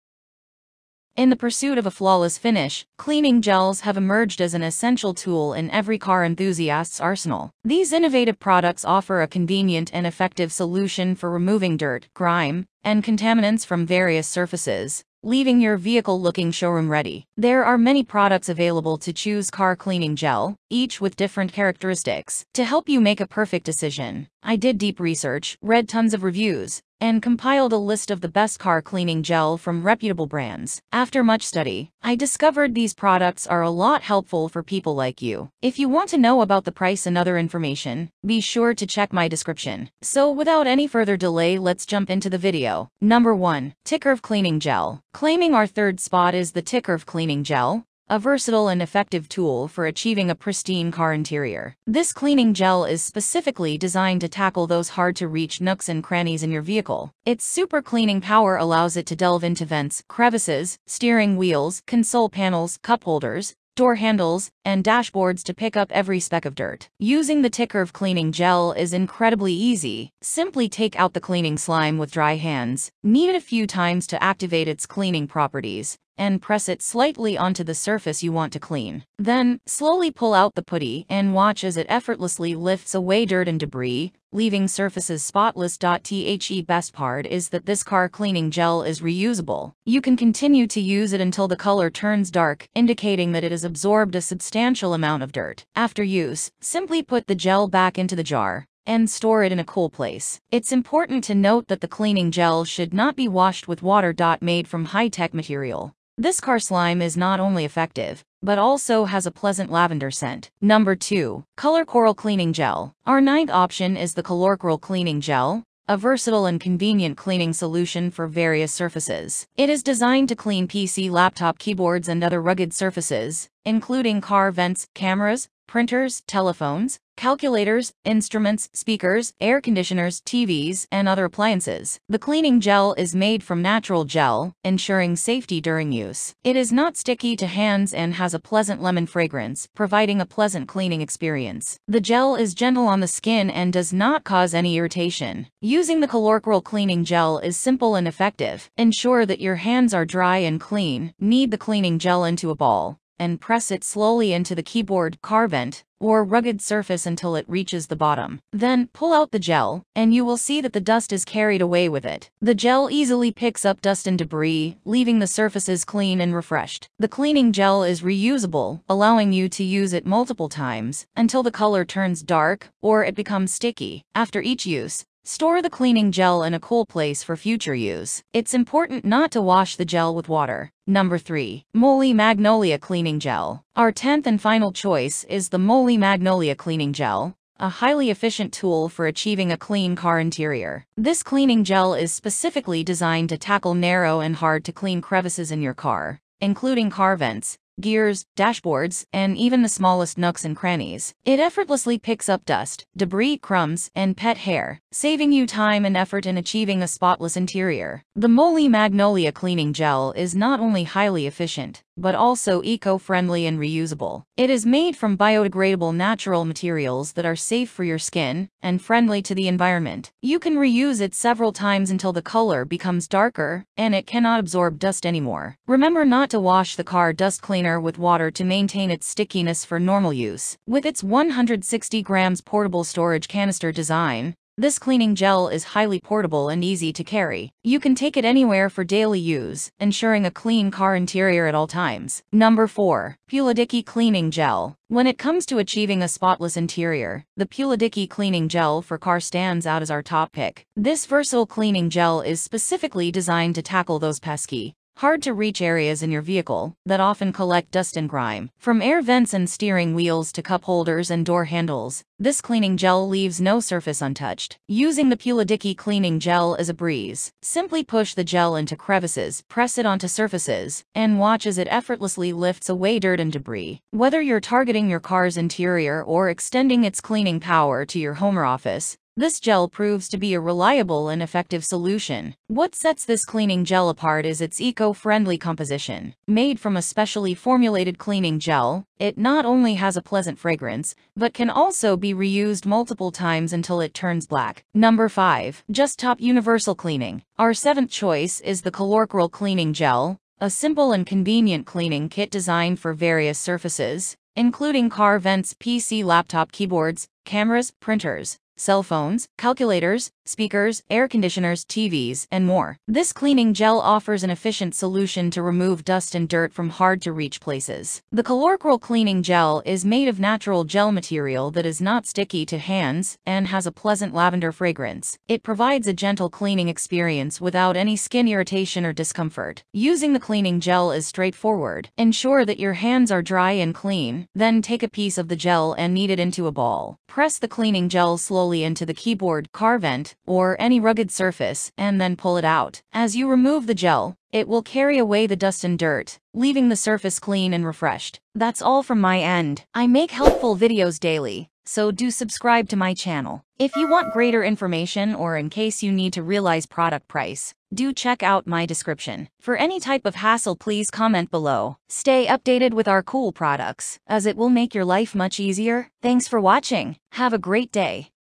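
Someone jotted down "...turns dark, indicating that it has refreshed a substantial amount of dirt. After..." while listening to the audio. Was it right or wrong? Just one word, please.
wrong.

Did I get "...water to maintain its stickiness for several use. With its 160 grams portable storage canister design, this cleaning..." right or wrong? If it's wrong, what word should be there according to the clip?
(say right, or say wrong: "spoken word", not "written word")
wrong: "normal", not "several".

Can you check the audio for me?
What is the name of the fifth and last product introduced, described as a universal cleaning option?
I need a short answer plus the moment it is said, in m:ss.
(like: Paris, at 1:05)
Just Top Universal Cleaning, at 4:55.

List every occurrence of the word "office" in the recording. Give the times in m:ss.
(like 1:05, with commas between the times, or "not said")
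4:38.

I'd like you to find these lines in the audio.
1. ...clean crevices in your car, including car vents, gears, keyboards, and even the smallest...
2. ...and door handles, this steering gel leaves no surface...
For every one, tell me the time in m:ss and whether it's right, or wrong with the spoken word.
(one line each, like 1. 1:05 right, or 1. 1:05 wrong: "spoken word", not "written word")
1. 3:14 wrong: "dashboards", not "keyboards"
2. 4:21 wrong: "cleaning", not "steering".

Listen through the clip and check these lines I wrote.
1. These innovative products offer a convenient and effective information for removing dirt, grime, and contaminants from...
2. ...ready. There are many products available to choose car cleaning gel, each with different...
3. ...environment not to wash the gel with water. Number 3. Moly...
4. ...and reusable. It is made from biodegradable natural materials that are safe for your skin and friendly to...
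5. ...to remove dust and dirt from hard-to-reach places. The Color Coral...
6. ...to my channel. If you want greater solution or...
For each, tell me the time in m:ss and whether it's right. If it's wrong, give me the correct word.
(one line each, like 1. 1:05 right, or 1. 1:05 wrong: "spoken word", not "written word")
1. 0:07 wrong: "solution", not "information"
2. 0:16 right
3. 2:58 wrong: "important", not "environment"
4. 3:33 right
5. 5:15 right
6. 5:52 wrong: "information", not "solution".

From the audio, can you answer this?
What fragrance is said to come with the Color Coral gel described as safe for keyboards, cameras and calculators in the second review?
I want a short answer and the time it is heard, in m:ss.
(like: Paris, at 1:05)
lemon, at 2:18.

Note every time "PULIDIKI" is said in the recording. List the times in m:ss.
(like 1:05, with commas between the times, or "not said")
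4:03, 4:07, 4:25.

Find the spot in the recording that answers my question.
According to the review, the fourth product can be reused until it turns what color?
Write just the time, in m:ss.
4:54.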